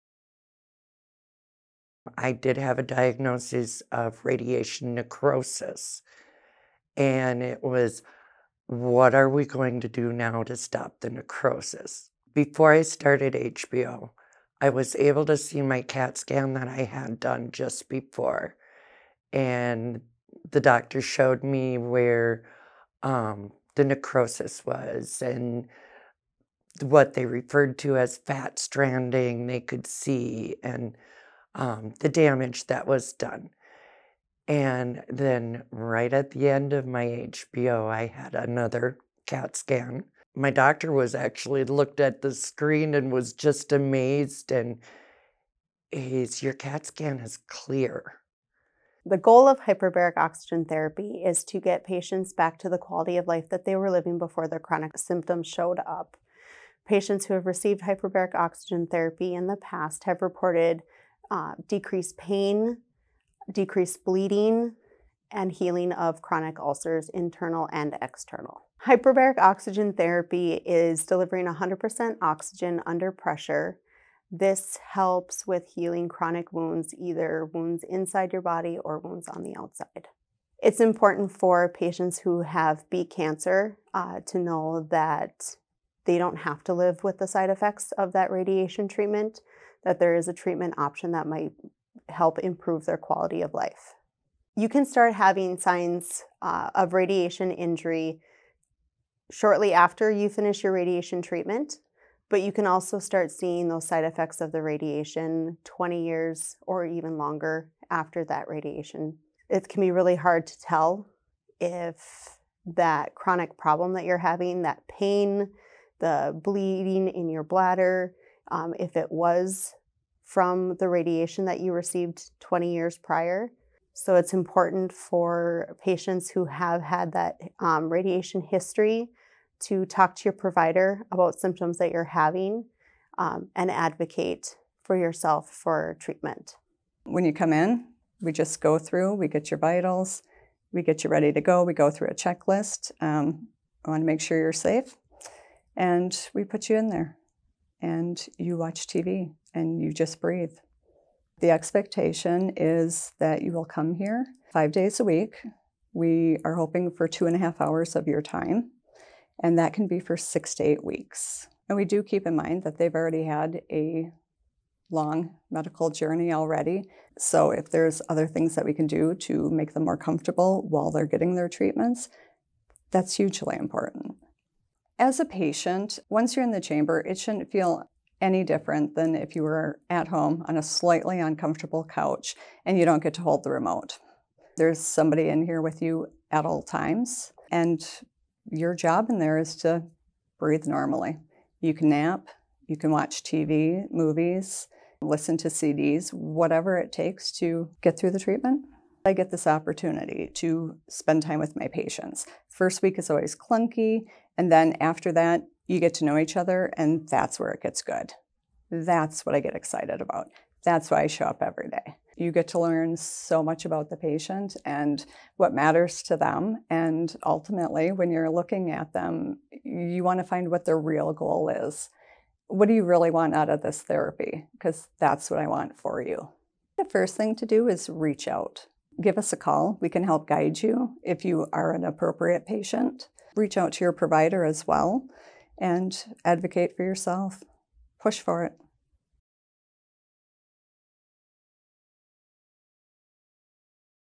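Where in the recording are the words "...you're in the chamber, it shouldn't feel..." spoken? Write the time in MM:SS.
02:56.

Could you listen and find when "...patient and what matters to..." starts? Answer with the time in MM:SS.
03:33.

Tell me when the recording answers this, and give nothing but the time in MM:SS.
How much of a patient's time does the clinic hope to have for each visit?
02:37.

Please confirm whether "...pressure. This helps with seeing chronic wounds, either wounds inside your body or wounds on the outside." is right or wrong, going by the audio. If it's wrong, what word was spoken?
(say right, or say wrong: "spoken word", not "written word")
wrong: "healing", not "seeing".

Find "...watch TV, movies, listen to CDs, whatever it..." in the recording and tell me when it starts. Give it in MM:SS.
03:12.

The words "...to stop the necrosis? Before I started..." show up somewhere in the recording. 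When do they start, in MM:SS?
00:10.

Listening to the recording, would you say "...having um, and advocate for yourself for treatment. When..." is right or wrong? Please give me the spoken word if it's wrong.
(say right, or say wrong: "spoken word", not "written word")
right.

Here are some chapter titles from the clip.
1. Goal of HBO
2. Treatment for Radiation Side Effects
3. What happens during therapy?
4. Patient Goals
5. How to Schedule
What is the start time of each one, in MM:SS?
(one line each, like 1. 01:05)
1. 00:48
2. 01:20
3. 02:17
4. 03:19
5. 03:46.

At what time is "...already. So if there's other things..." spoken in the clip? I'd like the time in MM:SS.
02:46.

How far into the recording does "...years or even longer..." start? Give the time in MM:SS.
01:46.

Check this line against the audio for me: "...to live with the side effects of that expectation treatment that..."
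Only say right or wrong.
wrong.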